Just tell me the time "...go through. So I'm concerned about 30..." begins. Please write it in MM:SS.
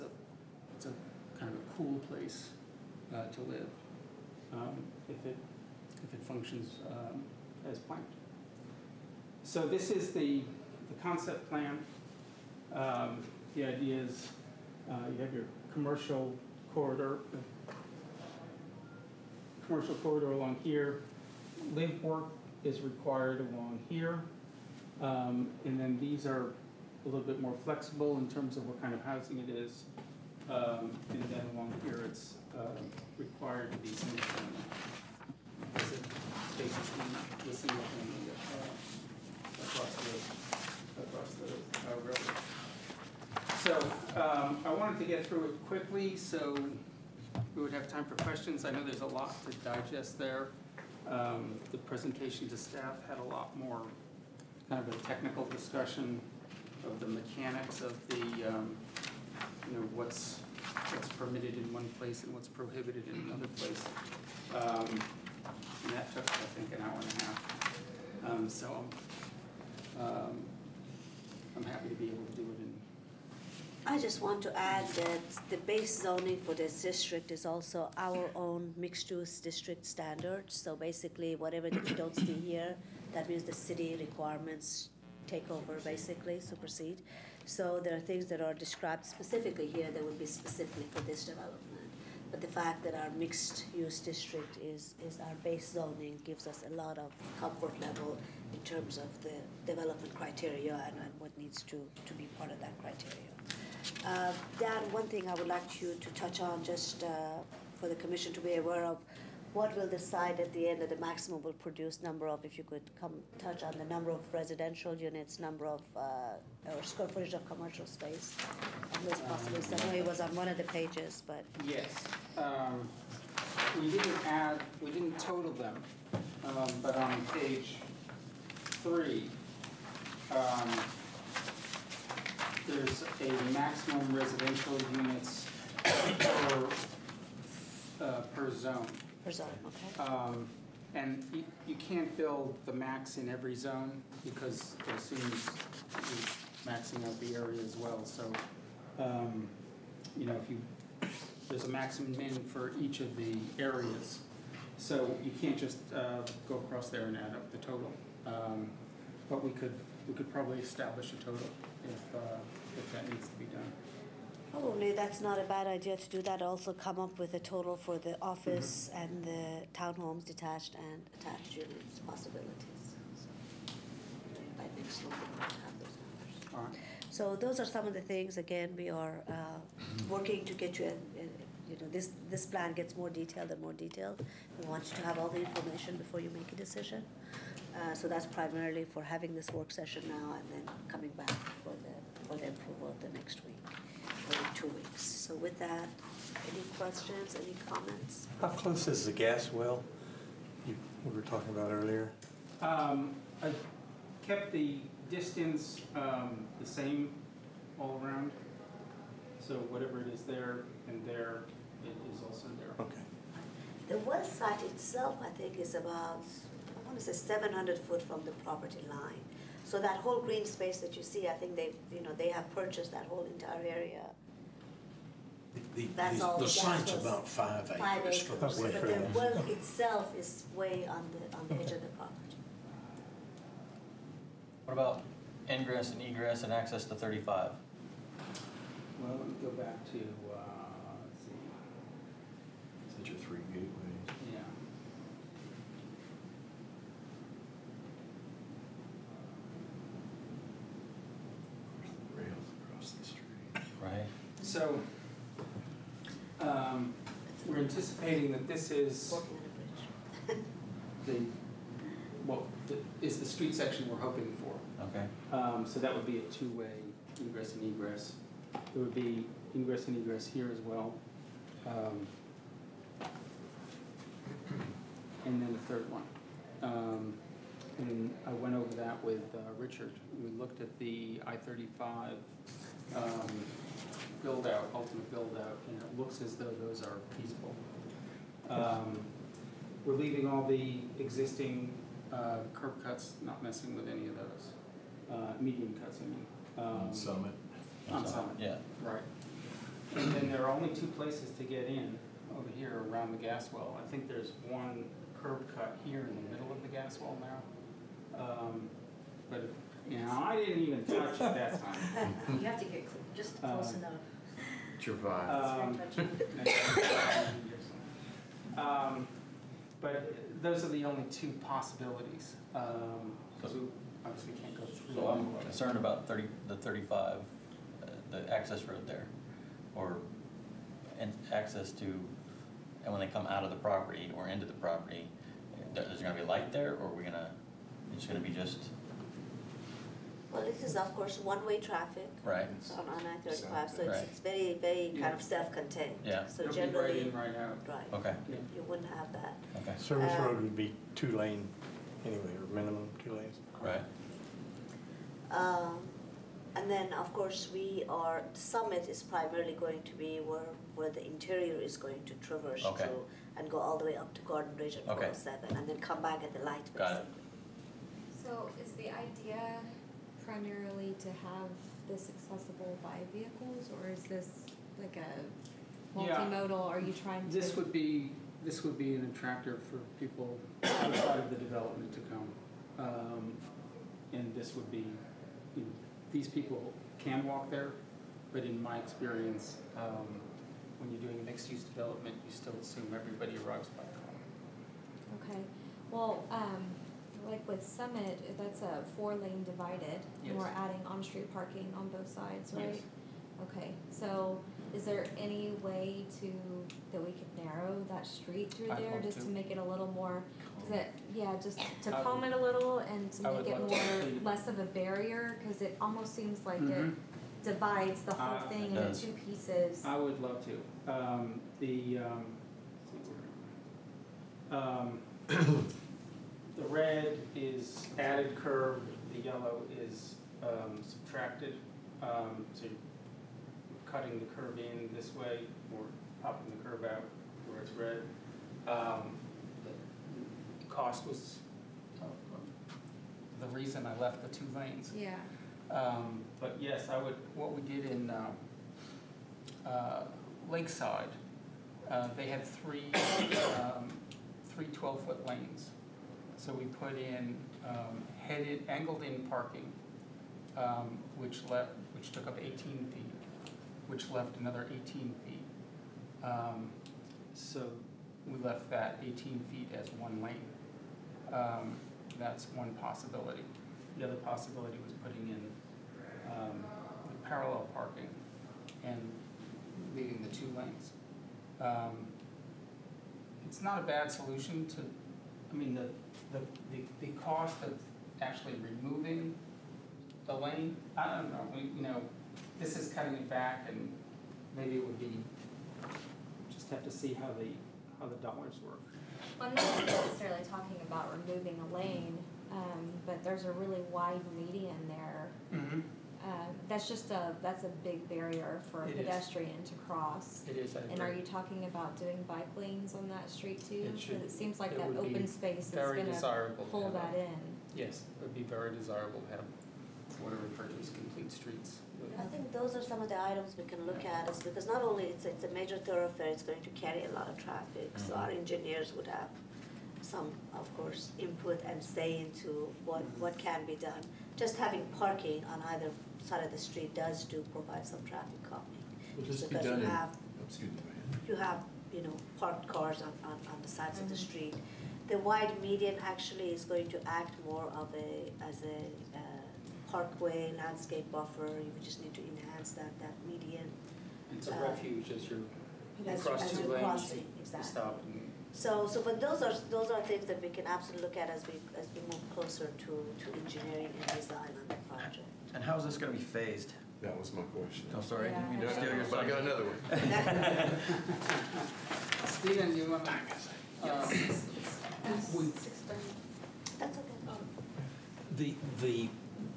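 05:24.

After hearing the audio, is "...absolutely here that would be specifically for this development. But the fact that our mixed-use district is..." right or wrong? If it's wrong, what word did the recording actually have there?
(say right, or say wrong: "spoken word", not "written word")
wrong: "specifically", not "absolutely".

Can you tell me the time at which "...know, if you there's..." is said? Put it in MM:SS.
02:30.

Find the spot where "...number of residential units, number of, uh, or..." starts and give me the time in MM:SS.
01:53.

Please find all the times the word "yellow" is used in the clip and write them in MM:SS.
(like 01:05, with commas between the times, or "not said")
07:09.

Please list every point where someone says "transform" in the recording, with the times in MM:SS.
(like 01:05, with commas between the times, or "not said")
not said.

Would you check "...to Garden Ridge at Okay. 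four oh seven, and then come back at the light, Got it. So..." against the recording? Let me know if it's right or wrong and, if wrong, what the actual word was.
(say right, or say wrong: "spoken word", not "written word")
right.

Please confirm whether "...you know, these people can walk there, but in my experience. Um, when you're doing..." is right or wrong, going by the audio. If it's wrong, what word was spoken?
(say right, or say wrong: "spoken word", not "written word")
right.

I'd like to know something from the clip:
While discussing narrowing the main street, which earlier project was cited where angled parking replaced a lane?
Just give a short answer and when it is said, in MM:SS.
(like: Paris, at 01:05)
Lakeside, at 07:30.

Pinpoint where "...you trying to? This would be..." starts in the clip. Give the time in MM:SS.
06:16.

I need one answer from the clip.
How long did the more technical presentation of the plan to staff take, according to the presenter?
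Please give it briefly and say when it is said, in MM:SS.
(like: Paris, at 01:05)
an hour and a half, at 01:06.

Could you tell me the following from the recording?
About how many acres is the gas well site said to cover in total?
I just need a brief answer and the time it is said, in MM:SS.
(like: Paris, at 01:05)
5 acres, at 03:47.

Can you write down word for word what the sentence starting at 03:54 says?
What about ingress and egress and access to 35?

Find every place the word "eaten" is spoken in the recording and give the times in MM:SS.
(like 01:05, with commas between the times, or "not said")
not said.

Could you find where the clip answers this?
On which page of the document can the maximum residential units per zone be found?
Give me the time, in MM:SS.
02:07.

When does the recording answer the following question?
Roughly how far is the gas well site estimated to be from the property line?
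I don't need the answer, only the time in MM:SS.
03:37.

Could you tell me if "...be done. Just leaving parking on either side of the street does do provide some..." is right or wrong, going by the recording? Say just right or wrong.
wrong.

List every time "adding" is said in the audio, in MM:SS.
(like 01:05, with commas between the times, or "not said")
06:40.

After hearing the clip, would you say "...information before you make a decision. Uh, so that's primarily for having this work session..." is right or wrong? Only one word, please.
right.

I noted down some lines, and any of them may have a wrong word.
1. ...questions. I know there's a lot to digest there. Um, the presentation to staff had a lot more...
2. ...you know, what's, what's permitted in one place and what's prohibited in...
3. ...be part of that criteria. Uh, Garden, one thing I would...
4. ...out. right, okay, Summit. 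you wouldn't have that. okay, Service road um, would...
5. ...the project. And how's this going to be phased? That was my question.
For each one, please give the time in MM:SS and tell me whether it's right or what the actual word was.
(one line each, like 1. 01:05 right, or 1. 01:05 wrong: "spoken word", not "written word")
1. 00:48 right
2. 00:59 right
3. 01:42 wrong: "Dan", not "Garden"
4. 05:47 wrong: "Yeah", not "Summit"
5. 09:24 right.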